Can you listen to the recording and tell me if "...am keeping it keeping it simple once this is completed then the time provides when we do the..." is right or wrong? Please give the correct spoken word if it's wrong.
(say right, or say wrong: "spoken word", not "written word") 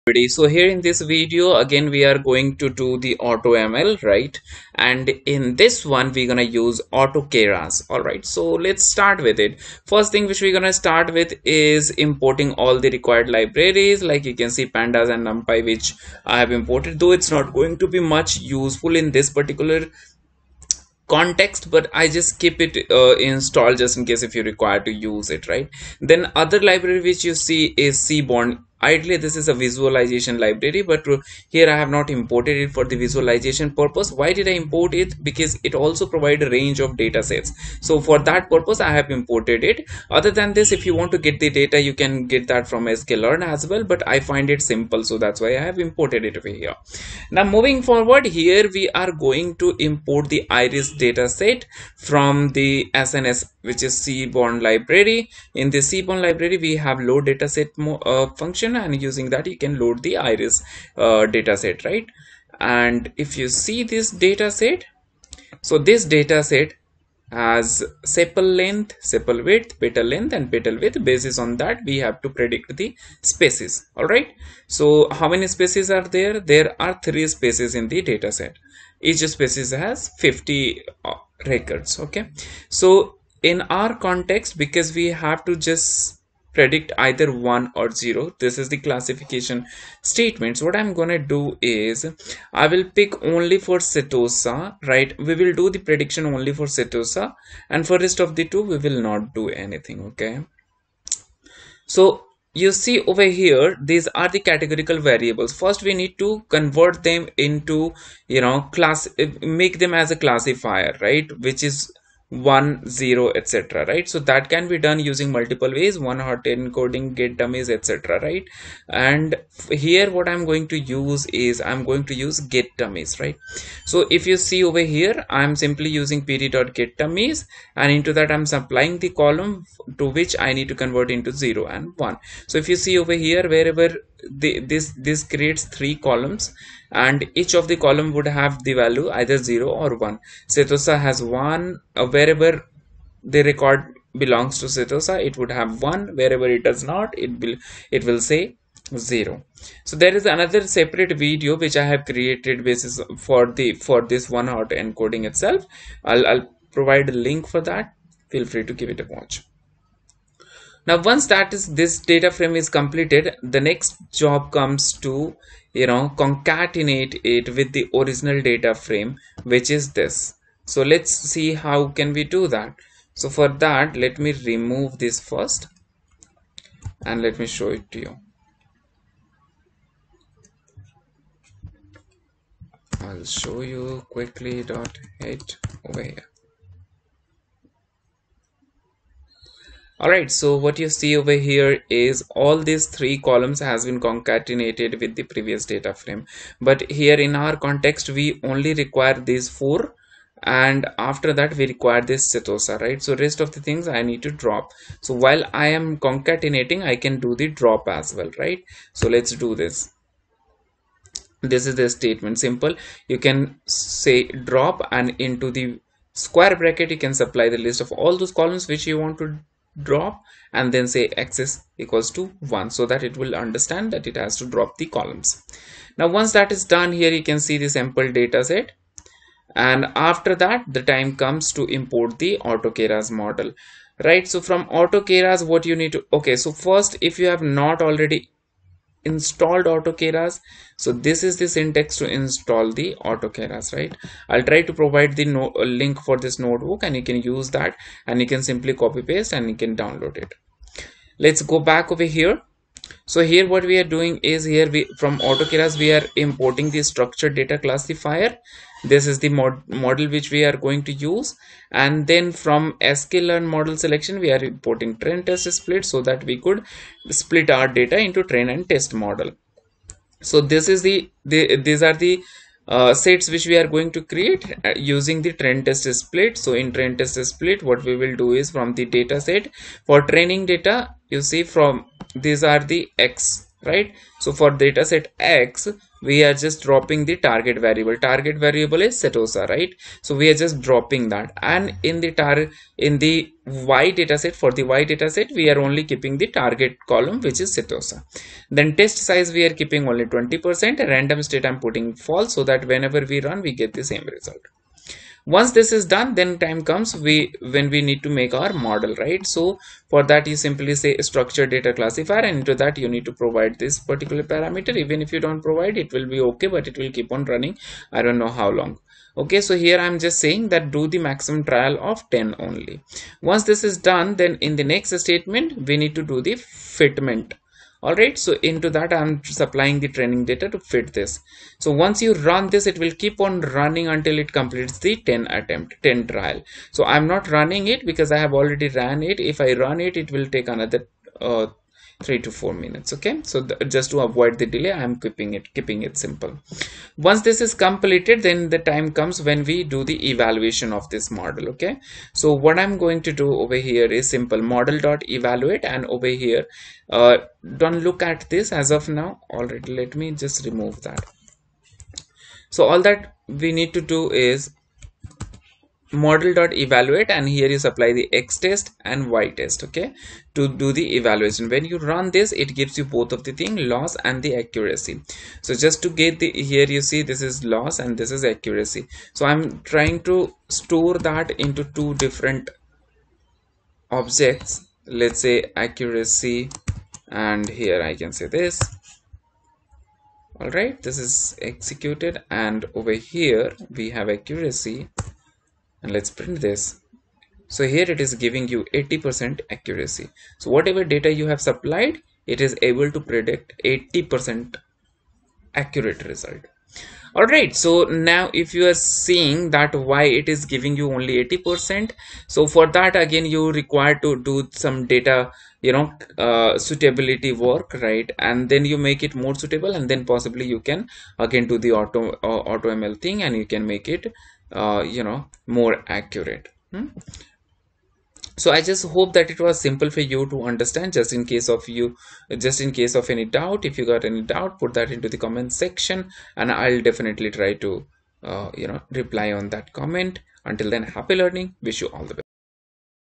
wrong: "comes", not "provides".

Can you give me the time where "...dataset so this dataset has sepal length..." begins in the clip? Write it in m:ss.
1:04.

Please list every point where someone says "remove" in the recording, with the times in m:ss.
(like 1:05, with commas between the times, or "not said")
2:54, 6:00.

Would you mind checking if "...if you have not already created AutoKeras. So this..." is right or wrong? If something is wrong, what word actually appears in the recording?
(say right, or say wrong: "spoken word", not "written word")
wrong: "installed", not "created".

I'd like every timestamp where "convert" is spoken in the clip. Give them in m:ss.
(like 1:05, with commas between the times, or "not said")
1:46, 2:10.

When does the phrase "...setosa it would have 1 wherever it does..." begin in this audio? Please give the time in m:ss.
2:24.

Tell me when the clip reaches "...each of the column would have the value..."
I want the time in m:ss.
2:17.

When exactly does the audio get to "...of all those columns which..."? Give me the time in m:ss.
3:37.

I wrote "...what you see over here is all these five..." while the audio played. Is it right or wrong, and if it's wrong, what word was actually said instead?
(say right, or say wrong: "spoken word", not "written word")
wrong: "three", not "five".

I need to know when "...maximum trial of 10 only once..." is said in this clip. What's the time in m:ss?
5:20.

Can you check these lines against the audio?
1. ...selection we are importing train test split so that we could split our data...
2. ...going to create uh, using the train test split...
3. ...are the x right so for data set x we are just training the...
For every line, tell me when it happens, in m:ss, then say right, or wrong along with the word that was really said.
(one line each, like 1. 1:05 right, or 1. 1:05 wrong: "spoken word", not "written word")
1. 4:23 right
2. 4:33 right
3. 4:42 wrong: "dropping", not "training".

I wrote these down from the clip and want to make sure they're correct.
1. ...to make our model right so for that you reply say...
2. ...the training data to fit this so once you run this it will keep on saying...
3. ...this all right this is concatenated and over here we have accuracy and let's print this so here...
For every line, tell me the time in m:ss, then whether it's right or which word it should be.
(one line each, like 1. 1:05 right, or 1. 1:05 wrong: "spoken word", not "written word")
1. 5:08 wrong: "simply", not "reply"
2. 5:29 wrong: "running", not "saying"
3. 6:28 wrong: "executed", not "concatenated".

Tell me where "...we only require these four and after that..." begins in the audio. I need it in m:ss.
3:18.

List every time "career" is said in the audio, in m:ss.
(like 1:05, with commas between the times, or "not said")
not said.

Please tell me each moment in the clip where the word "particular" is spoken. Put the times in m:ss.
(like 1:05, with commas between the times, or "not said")
0:19, 5:13.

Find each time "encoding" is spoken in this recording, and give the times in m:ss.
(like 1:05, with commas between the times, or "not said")
1:56, 2:34.